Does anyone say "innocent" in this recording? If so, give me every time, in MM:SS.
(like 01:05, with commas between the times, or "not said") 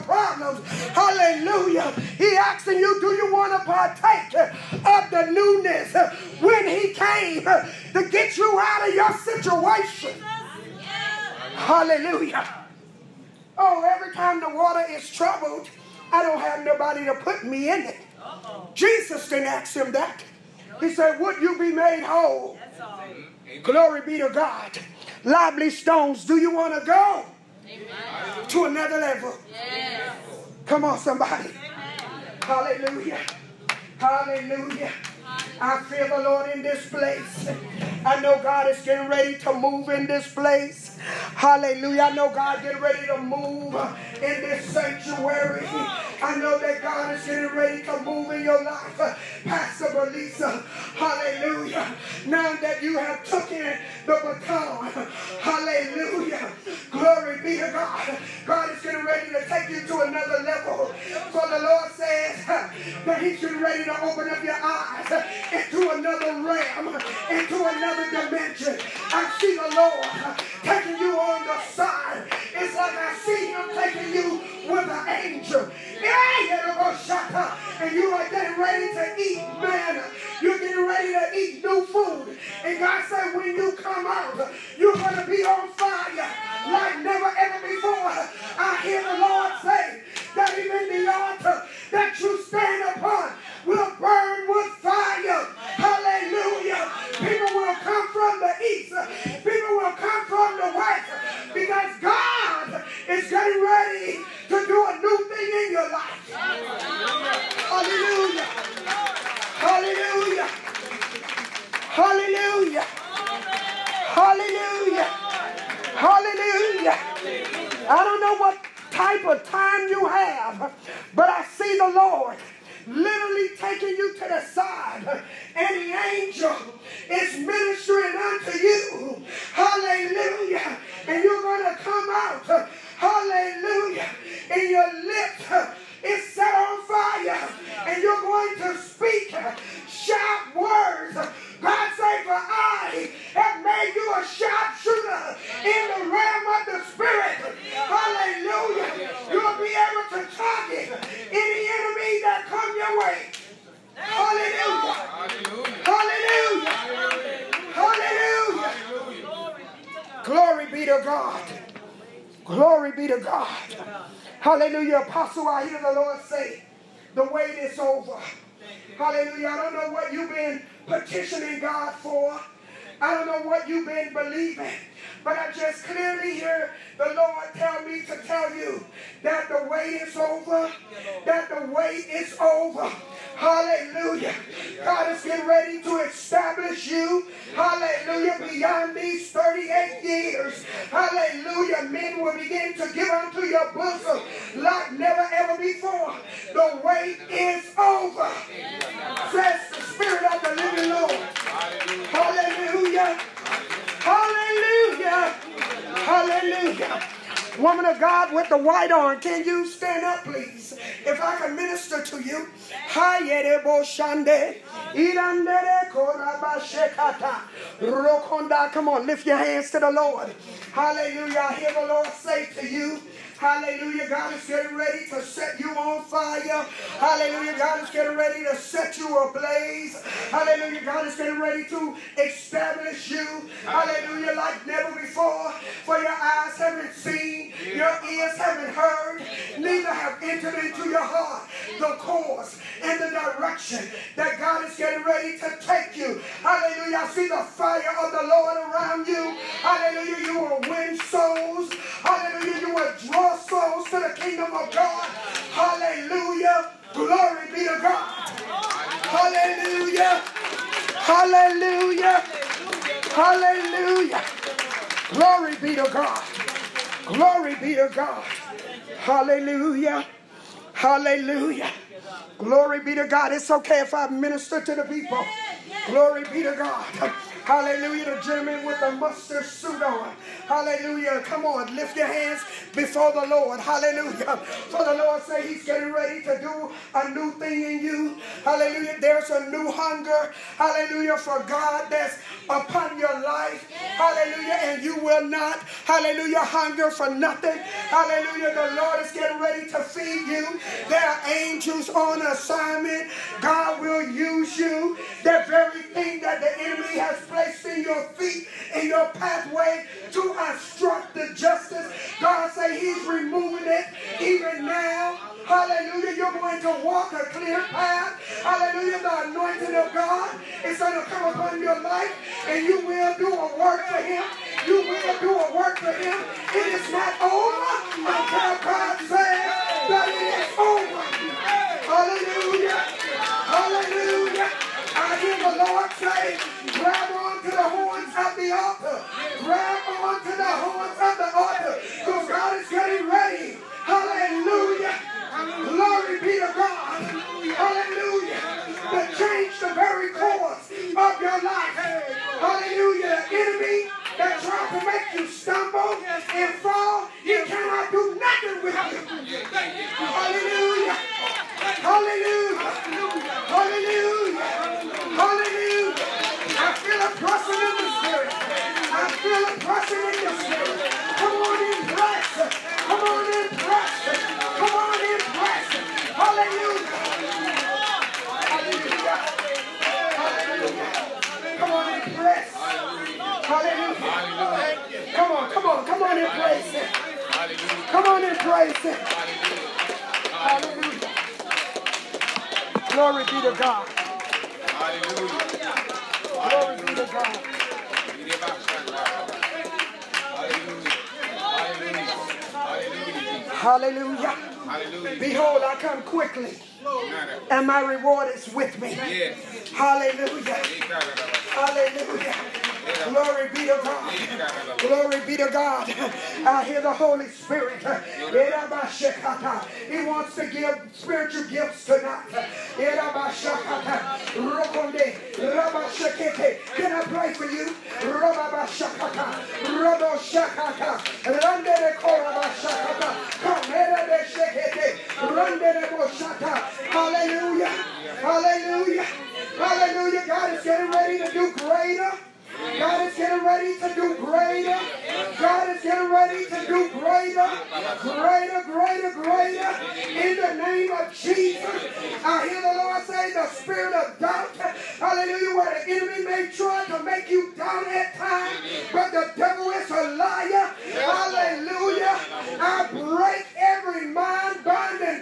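not said.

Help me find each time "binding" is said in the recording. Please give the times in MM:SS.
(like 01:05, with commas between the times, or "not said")
07:44.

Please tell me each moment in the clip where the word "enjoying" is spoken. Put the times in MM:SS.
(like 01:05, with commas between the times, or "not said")
not said.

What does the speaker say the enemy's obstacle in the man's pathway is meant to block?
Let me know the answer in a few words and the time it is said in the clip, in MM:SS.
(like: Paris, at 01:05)
Justice, at 05:11.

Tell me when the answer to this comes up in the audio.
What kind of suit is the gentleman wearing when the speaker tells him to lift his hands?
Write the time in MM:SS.
04:38.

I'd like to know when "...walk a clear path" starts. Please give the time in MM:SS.
05:16.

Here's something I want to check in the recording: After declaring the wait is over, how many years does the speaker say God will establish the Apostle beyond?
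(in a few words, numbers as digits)
38.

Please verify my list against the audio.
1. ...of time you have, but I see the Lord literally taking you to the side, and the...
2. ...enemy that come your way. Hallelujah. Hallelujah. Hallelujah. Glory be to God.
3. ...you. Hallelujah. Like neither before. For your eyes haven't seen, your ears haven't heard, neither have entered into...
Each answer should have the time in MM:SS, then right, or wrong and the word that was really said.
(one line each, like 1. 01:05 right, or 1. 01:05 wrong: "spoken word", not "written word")
1. 01:59 right
2. 02:31 right
3. 03:53 wrong: "never", not "neither".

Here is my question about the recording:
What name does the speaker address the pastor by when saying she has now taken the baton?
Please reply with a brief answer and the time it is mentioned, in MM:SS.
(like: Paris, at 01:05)
Belisa, at 00:49.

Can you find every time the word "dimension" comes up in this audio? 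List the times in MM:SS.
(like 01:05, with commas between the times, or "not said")
01:08.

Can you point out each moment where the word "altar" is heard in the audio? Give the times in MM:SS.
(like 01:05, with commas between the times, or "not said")
01:31.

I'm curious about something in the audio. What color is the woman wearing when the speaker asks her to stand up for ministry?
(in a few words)
White.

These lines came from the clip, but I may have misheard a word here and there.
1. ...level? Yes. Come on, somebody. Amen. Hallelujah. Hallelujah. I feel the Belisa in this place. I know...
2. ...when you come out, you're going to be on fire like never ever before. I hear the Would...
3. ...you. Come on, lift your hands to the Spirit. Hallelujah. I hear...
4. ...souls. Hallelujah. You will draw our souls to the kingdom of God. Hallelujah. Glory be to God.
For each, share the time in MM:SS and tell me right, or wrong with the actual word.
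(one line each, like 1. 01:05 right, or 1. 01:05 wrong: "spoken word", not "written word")
1. 00:28 wrong: "Lord", not "Belisa"
2. 01:23 wrong: "Lord", not "Would"
3. 03:32 wrong: "Lord", not "Spirit"
4. 04:10 right.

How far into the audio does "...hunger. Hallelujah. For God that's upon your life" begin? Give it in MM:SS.
04:49.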